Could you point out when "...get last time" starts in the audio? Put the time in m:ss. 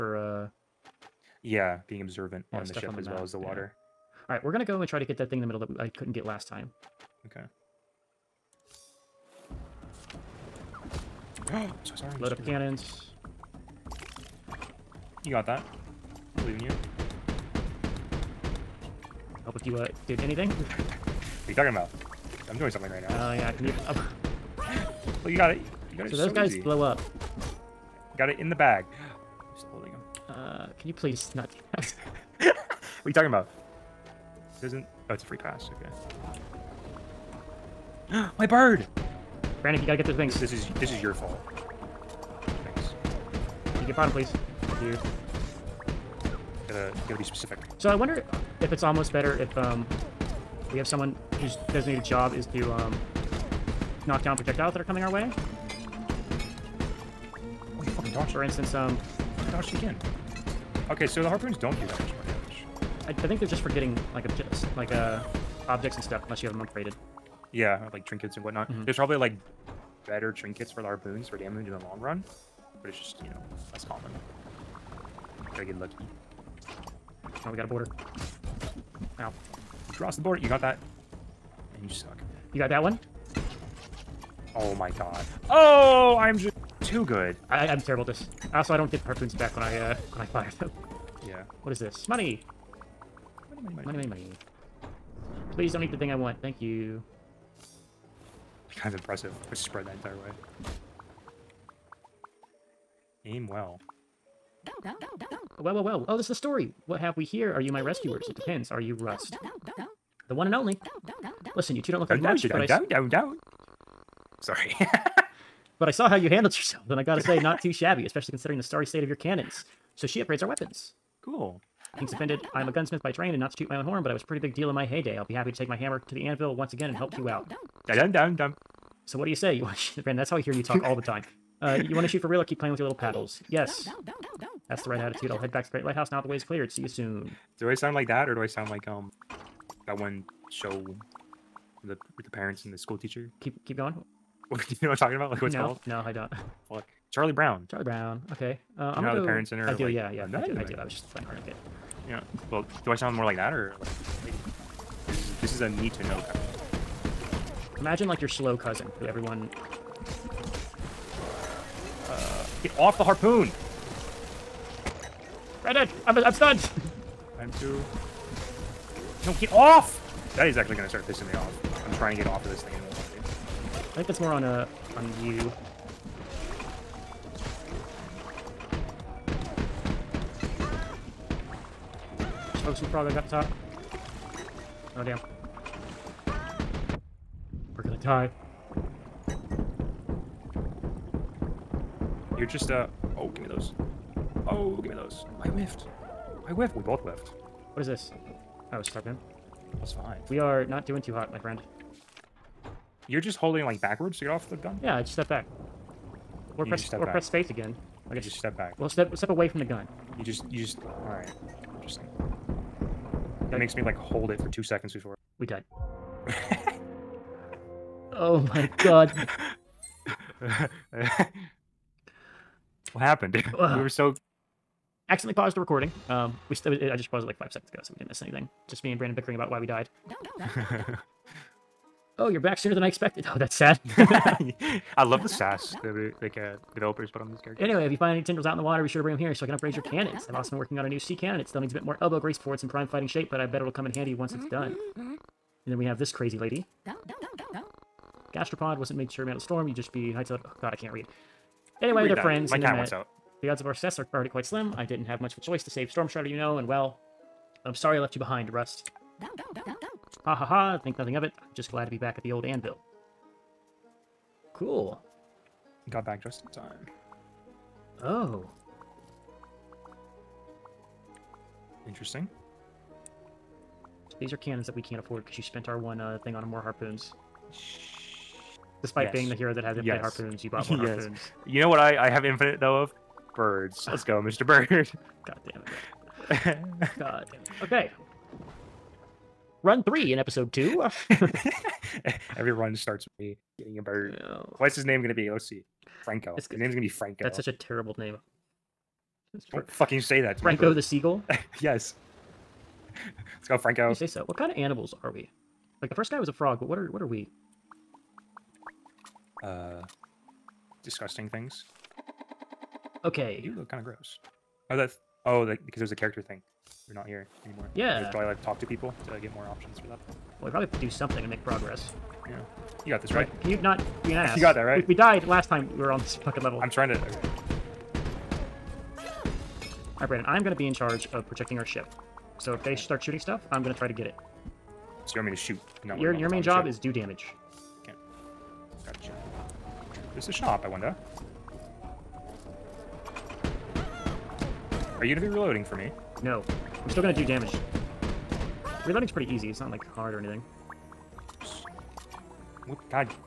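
0:06.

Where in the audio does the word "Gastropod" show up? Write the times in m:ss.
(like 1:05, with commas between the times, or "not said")
4:08.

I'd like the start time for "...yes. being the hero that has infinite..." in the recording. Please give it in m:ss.
4:39.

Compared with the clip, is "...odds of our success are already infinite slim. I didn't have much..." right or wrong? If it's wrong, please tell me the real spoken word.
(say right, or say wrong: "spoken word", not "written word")
wrong: "quite", not "infinite".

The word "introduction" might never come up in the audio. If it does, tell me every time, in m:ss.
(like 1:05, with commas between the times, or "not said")
not said.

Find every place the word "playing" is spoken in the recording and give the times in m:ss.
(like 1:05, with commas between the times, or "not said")
2:12, 2:31.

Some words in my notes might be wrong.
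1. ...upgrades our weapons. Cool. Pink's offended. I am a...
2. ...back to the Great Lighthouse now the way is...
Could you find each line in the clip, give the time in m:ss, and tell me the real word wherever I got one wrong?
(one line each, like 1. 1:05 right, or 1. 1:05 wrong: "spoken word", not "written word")
1. 2:00 right
2. 2:15 right.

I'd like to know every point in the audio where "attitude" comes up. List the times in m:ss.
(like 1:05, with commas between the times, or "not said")
2:14.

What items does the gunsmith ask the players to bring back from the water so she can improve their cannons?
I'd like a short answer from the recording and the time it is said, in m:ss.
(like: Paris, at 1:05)
Tendrils, at 3:58.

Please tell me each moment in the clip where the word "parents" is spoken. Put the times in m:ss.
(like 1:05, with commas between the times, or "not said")
2:22, 2:29.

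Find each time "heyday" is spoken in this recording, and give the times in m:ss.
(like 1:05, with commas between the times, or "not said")
2:04.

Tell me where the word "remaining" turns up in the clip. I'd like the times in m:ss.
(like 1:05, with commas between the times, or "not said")
not said.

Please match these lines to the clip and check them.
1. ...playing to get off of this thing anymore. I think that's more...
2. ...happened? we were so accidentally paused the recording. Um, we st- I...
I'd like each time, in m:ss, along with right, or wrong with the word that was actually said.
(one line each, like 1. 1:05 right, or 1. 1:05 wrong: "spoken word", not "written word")
1. 2:51 wrong: "trying", not "playing"
2. 3:43 right.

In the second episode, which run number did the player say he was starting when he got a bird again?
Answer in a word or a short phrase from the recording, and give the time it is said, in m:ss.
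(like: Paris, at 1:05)
3, at 4:49.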